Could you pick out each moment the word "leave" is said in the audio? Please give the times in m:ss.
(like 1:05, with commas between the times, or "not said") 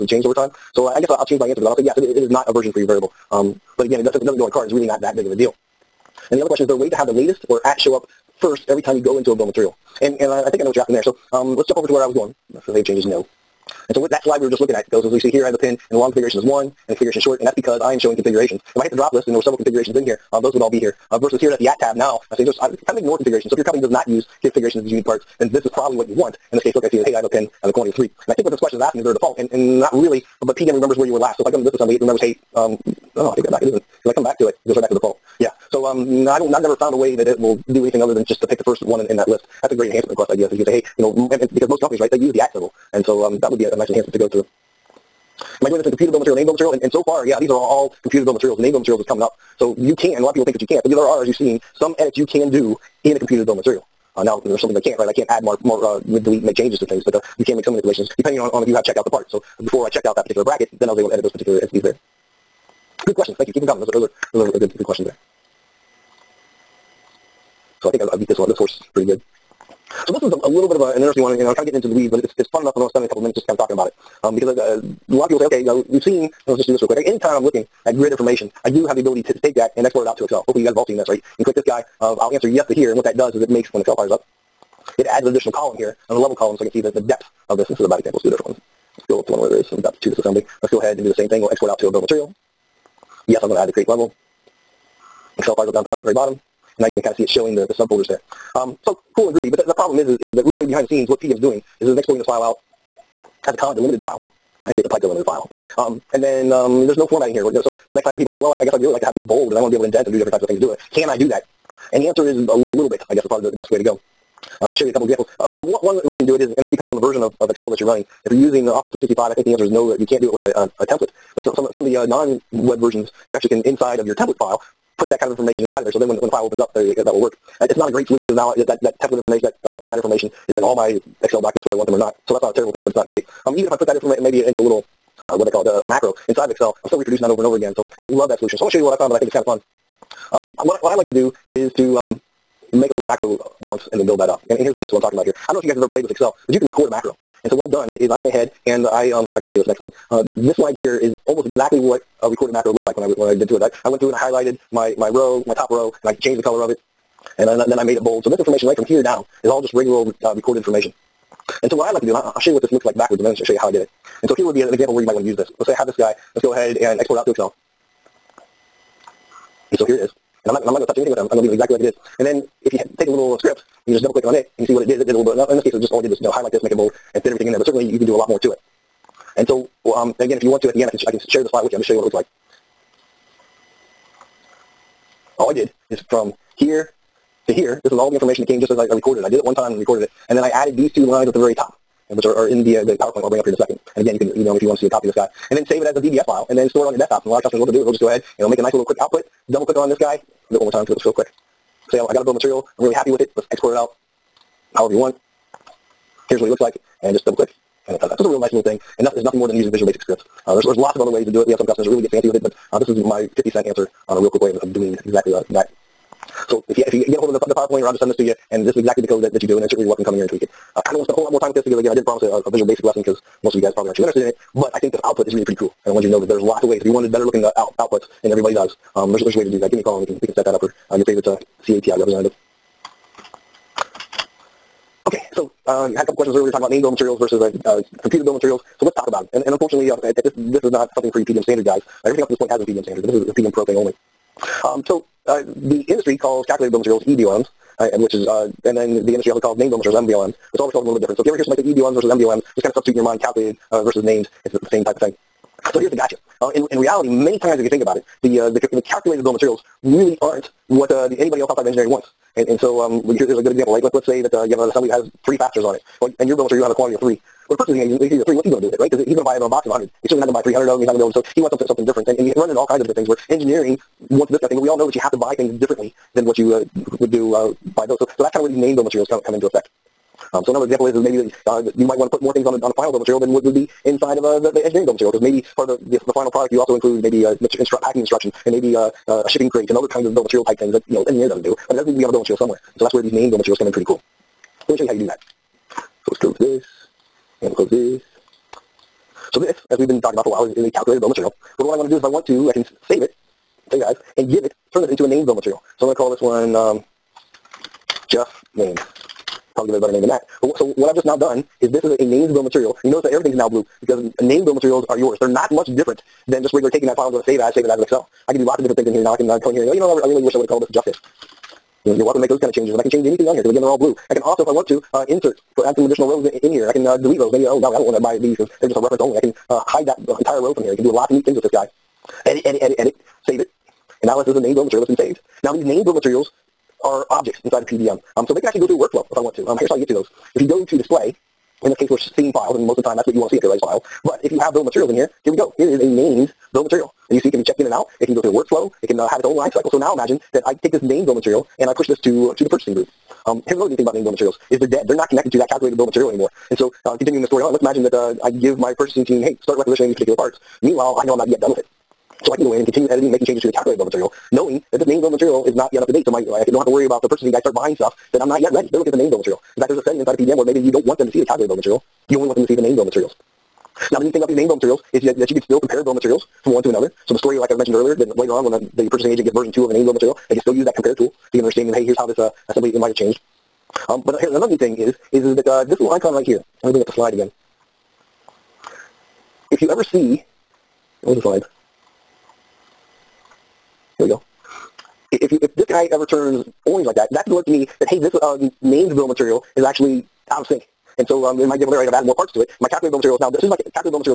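2:51.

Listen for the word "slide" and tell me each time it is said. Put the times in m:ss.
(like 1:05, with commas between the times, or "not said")
0:14, 2:30, 6:26, 6:31.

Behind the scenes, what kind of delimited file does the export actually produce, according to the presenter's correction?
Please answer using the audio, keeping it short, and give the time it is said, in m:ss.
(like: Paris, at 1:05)
pipe delimited, at 1:44.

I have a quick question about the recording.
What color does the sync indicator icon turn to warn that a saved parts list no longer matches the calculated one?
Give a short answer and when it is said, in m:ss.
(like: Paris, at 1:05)
orange, at 6:36.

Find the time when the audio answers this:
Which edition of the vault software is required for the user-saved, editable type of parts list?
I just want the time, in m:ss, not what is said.
4:03.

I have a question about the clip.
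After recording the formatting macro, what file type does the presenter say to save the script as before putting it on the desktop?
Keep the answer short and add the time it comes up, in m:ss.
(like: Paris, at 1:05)
VBS, at 3:15.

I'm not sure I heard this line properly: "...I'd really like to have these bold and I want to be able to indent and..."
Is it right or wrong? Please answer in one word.
right.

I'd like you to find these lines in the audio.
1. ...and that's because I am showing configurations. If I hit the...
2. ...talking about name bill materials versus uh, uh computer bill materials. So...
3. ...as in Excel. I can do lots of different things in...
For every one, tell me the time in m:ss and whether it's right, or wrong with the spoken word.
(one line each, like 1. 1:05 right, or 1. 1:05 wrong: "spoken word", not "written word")
1. 0:17 right
2. 3:56 right
3. 5:17 right.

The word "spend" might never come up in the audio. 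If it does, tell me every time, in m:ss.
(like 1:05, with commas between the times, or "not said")
1:12, 3:41.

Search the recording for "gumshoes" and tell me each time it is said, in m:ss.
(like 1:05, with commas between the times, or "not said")
not said.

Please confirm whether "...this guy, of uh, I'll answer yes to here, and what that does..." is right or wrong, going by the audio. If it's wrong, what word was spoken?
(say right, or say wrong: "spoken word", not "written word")
right.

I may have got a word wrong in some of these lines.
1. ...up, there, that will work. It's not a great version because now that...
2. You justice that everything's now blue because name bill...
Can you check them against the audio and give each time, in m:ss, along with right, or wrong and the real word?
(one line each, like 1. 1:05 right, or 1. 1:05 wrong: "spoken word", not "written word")
1. 2:06 wrong: "solution", not "version"
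2. 5:12 wrong: "notice", not "justice".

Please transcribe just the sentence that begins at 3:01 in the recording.
I'll just show you what it looks like.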